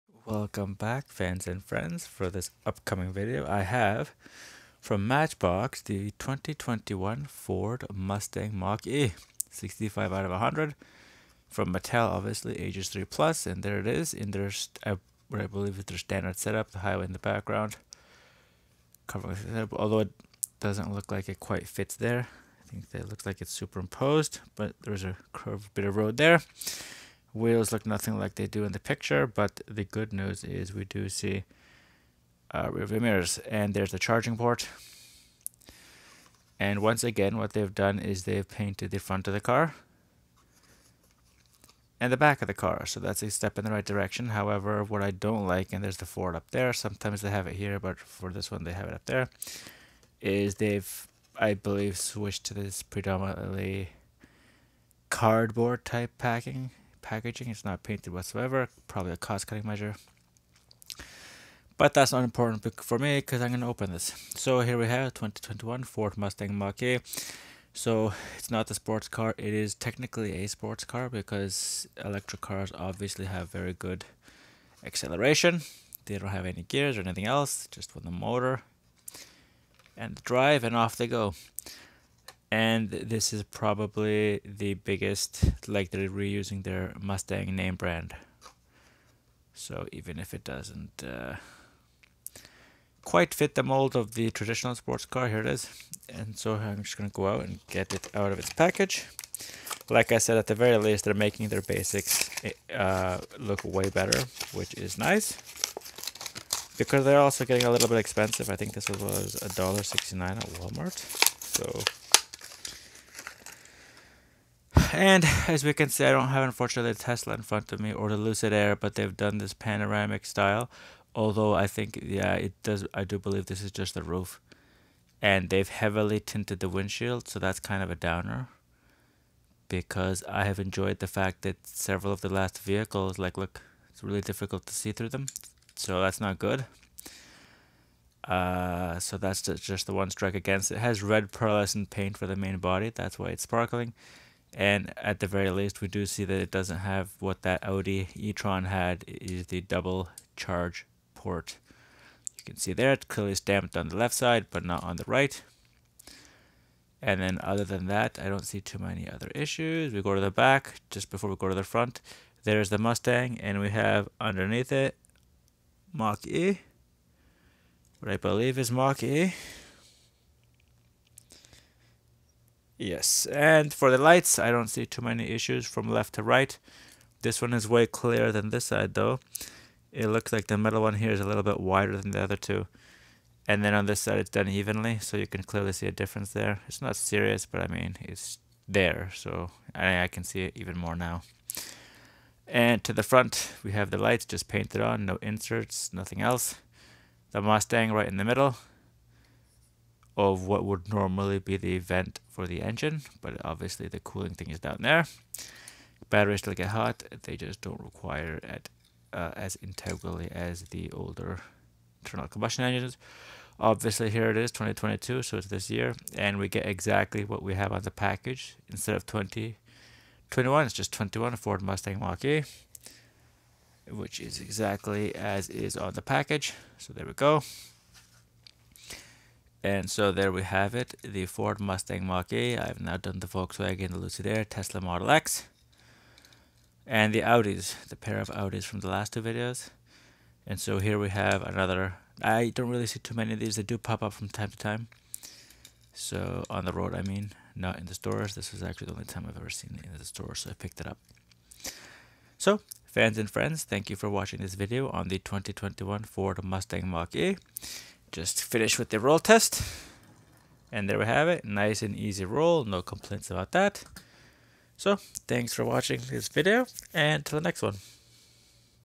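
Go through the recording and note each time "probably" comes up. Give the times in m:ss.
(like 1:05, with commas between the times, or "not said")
0:58, 1:23.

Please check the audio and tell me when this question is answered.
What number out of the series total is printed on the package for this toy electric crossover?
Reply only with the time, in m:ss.
0:09.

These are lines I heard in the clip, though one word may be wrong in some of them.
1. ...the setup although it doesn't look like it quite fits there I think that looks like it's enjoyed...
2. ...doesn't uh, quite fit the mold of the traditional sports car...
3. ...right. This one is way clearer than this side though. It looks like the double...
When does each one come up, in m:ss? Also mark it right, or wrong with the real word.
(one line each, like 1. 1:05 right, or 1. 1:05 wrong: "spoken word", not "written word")
1. 0:19 wrong: "superimposed", not "enjoyed"
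2. 1:30 right
3. 2:56 wrong: "middle", not "double".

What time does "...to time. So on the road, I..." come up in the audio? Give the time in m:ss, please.
4:04.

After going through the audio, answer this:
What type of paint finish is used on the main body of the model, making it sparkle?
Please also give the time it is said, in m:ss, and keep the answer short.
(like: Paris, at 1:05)
red pearlescent, at 2:21.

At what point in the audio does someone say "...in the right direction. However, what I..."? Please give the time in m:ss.
0:43.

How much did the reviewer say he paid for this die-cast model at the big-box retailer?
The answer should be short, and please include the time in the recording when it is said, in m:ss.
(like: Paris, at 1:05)
$1.69, at 1:49.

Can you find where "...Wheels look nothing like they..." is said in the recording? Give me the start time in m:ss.
0:27.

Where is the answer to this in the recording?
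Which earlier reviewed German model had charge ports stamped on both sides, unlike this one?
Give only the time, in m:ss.
2:27.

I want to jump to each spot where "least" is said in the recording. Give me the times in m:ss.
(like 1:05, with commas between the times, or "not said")
1:40, 2:25.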